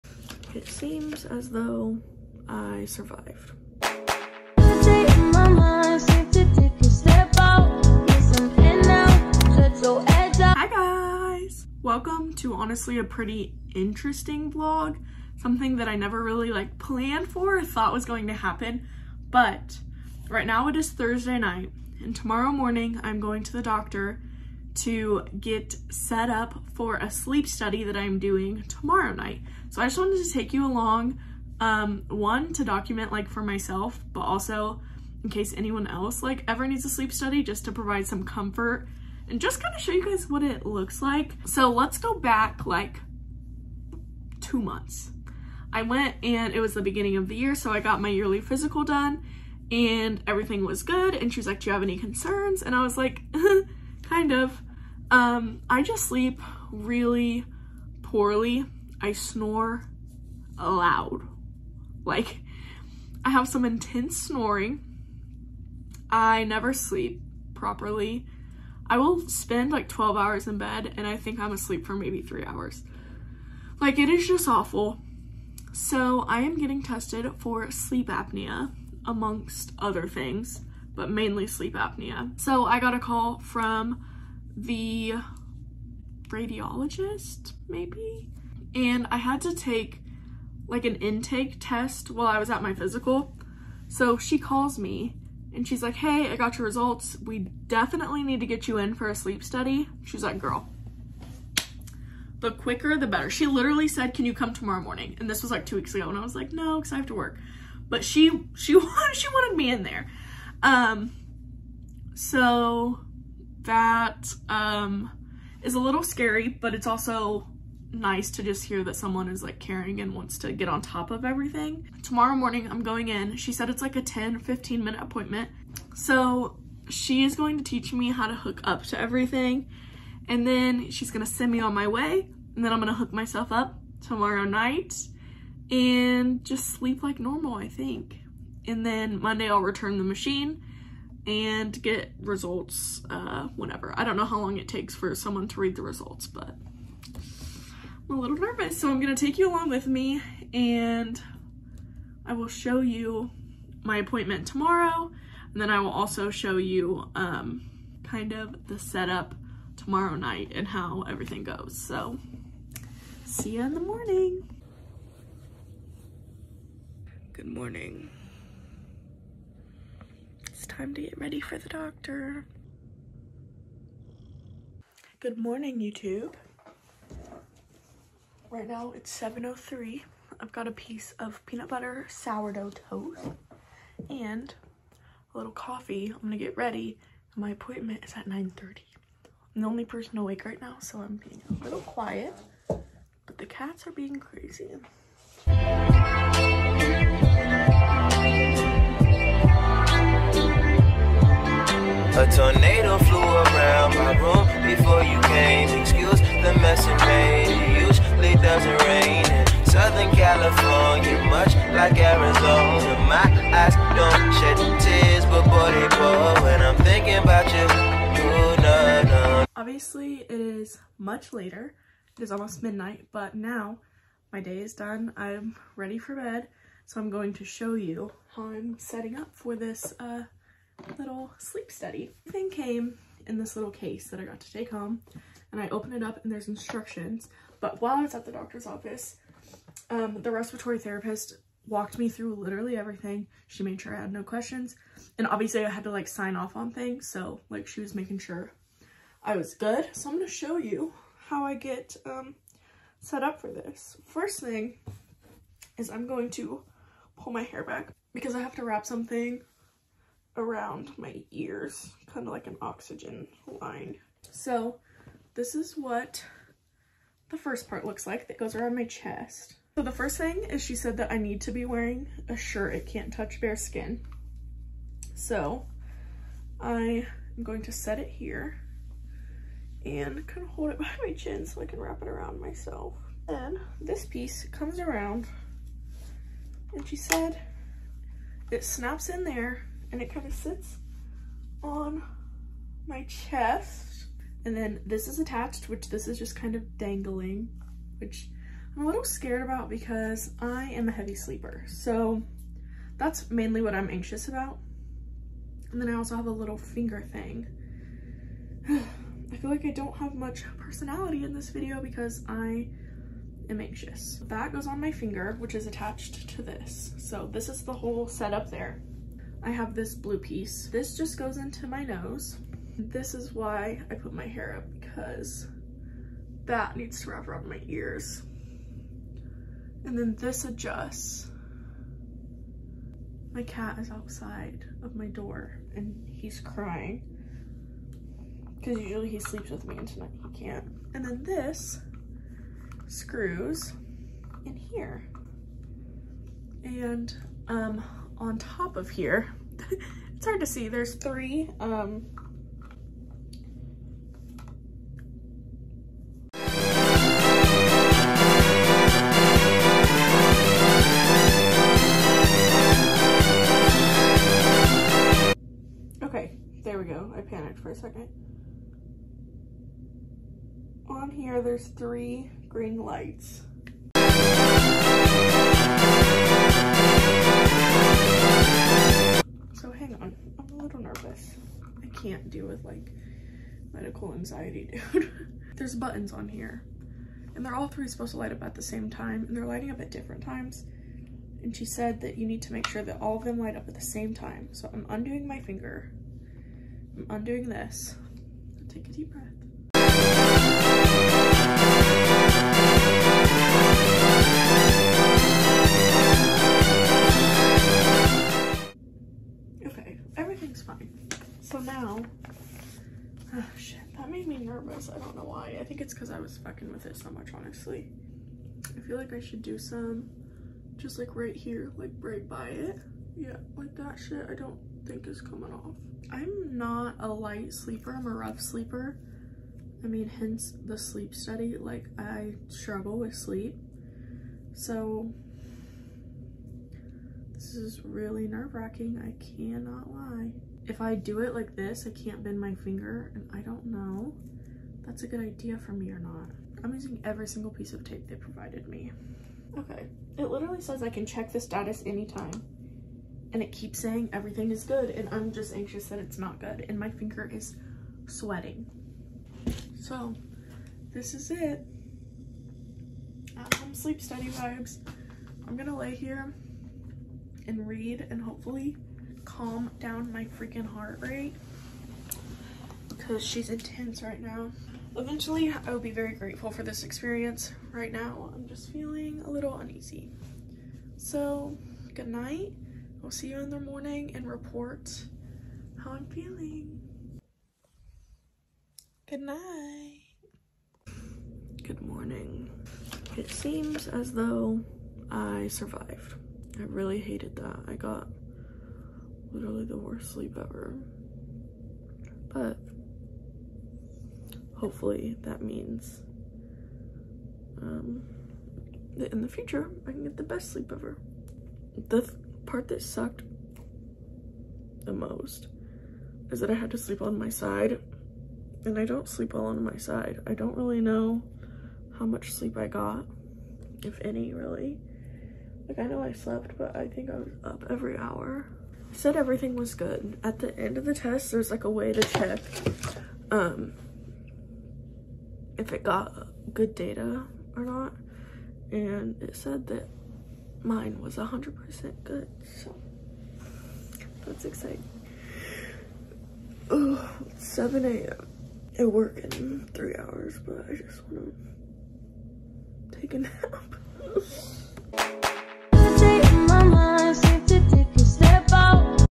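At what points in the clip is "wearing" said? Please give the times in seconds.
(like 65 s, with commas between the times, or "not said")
271 s.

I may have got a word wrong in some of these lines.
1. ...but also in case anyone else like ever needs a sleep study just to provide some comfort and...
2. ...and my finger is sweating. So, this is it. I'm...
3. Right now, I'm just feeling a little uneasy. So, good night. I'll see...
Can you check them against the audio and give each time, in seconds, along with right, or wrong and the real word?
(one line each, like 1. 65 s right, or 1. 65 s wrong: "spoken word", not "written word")
1. 34 s right
2. 456 s right
3. 477 s right.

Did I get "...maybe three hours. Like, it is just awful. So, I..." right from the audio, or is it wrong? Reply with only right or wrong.
right.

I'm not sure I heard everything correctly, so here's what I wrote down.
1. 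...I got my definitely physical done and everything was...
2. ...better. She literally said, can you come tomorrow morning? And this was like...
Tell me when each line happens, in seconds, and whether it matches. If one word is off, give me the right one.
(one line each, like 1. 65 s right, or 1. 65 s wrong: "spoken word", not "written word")
1. 47 s wrong: "yearly", not "definitely"
2. 103 s right.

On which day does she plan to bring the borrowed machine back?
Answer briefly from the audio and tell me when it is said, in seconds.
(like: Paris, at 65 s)
Monday, at 139 s.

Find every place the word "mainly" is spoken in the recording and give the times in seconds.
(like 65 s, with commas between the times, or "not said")
81 s, 303 s.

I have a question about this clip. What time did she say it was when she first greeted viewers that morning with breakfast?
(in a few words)
7:03.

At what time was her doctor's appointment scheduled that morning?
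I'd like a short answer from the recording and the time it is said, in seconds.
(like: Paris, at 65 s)
9:30, at 188 s.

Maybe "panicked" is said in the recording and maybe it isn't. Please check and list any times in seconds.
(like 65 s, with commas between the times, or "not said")
367 s.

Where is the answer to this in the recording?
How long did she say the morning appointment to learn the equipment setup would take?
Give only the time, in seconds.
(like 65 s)
124 s.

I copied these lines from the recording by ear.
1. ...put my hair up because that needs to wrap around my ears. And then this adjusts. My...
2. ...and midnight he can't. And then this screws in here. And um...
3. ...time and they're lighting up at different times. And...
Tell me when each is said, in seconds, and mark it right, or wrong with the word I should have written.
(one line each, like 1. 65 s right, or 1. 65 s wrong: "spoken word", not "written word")
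1. 323 s right
2. 339 s wrong: "tonight", not "midnight"
3. 388 s right.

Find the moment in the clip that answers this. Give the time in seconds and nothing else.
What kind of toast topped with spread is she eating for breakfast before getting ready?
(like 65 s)
181 s.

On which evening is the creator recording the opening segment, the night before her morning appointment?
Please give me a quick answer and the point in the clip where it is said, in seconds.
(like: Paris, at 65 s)
Thursday, at 20 s.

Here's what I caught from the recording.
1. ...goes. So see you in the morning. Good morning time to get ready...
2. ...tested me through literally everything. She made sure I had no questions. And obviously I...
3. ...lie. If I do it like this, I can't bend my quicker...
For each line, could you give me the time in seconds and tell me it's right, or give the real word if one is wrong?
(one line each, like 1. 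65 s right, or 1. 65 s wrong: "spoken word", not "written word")
1. 161 s right
2. 241 s wrong: "walked", not "tested"
3. 439 s wrong: "finger", not "quicker".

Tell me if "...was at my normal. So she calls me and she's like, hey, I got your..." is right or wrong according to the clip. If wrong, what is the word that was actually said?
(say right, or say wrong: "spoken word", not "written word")
wrong: "physical", not "normal".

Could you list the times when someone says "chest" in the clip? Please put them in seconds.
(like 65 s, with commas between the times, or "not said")
268 s, 293 s.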